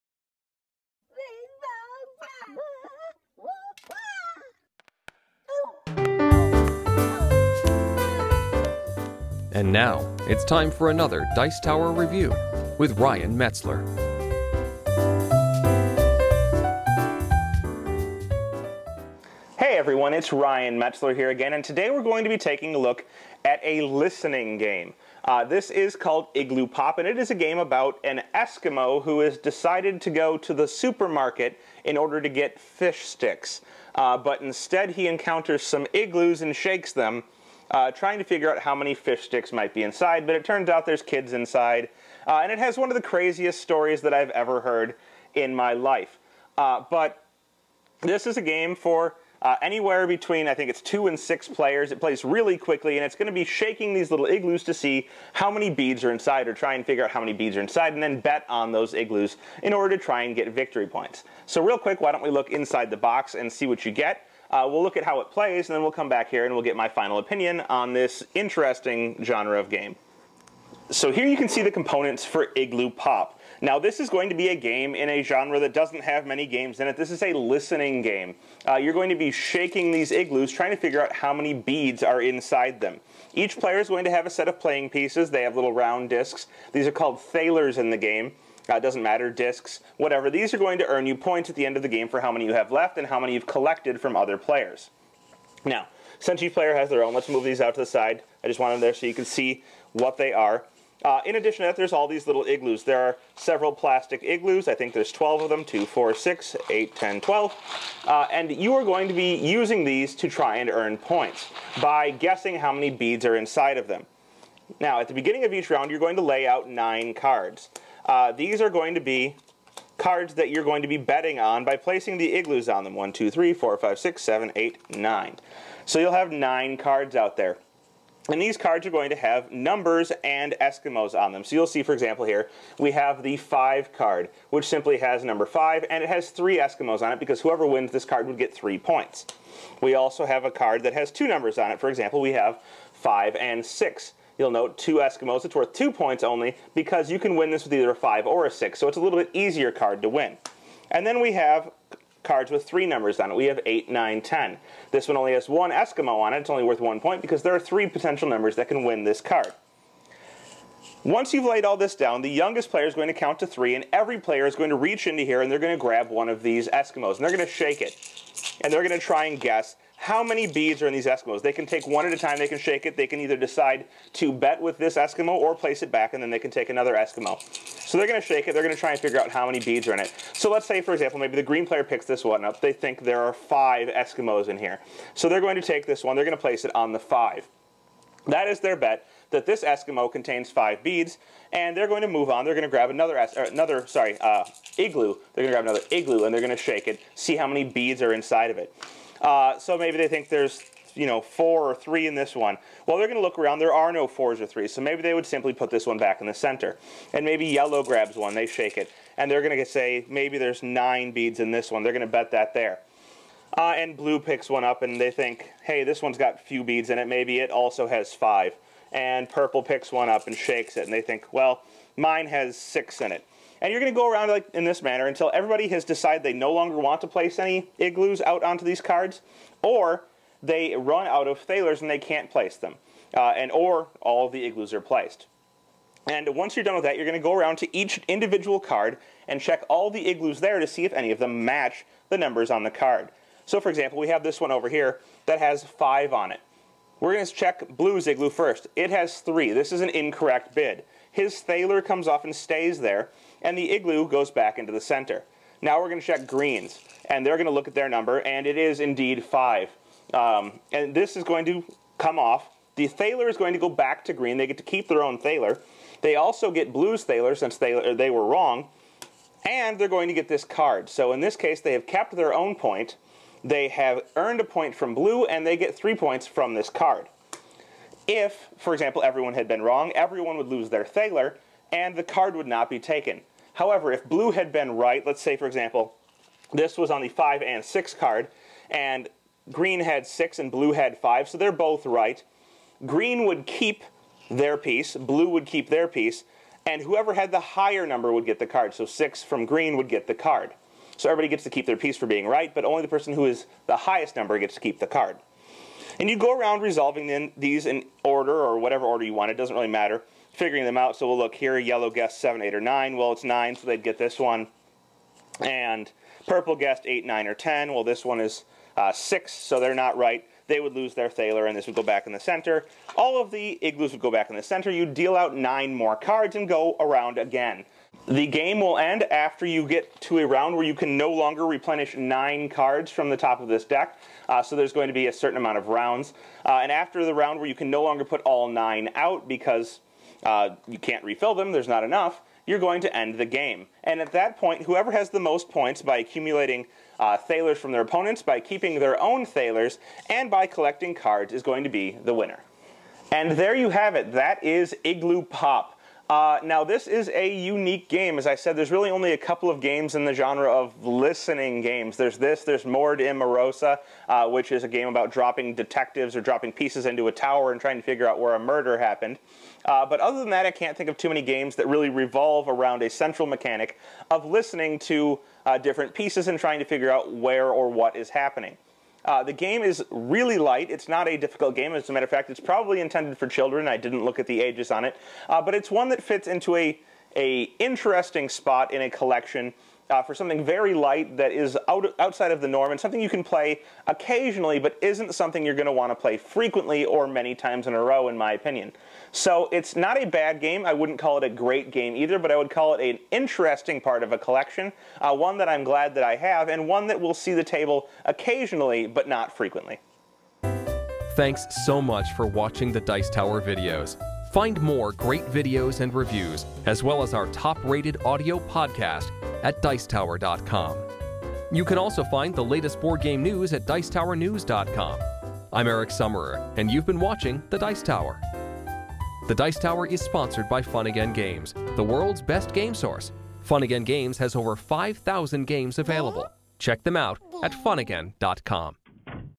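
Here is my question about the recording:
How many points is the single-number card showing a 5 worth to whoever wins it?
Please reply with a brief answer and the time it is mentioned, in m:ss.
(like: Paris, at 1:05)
3, at 2:18.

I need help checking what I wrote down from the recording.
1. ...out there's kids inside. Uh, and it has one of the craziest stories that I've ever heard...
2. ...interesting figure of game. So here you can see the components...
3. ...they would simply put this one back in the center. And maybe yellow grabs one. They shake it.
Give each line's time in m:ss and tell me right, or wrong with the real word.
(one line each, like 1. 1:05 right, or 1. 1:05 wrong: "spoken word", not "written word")
1. 0:40 right
2. 1:08 wrong: "genre", not "figure"
3. 3:25 right.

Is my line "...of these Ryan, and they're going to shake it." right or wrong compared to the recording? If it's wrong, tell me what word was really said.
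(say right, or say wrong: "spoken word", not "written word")
wrong: "Eskimos", not "Ryan".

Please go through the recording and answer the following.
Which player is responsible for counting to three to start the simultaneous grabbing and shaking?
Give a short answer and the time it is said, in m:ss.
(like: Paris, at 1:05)
The youngest player, at 2:42.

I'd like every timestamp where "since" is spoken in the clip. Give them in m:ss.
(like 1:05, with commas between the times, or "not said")
1:36, 4:27.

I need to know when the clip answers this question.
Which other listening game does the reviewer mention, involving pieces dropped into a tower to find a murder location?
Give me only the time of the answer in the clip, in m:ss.
6:02.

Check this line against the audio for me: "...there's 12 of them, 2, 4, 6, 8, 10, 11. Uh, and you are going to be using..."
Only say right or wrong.
wrong.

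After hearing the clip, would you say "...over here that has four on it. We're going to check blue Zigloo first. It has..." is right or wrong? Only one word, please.
wrong.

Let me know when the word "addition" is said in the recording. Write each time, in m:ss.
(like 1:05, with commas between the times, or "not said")
1:41.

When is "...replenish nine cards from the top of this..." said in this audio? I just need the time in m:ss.
5:31.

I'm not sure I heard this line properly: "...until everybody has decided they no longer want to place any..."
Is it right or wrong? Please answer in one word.
right.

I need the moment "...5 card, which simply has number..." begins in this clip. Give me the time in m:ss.
2:13.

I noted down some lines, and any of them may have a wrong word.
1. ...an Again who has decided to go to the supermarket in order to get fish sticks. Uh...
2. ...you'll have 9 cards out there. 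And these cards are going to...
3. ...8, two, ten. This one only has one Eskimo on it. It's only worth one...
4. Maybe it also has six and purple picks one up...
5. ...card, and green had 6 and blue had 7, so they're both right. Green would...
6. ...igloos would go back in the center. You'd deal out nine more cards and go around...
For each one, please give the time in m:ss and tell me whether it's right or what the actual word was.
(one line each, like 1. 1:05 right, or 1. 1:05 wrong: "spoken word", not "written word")
1. 0:28 wrong: "Eskimo", not "Again"
2. 2:05 right
3. 2:33 wrong: "nine", not "two"
4. 3:37 wrong: "five", not "six"
5. 4:47 wrong: "5", not "7"
6. 5:23 right.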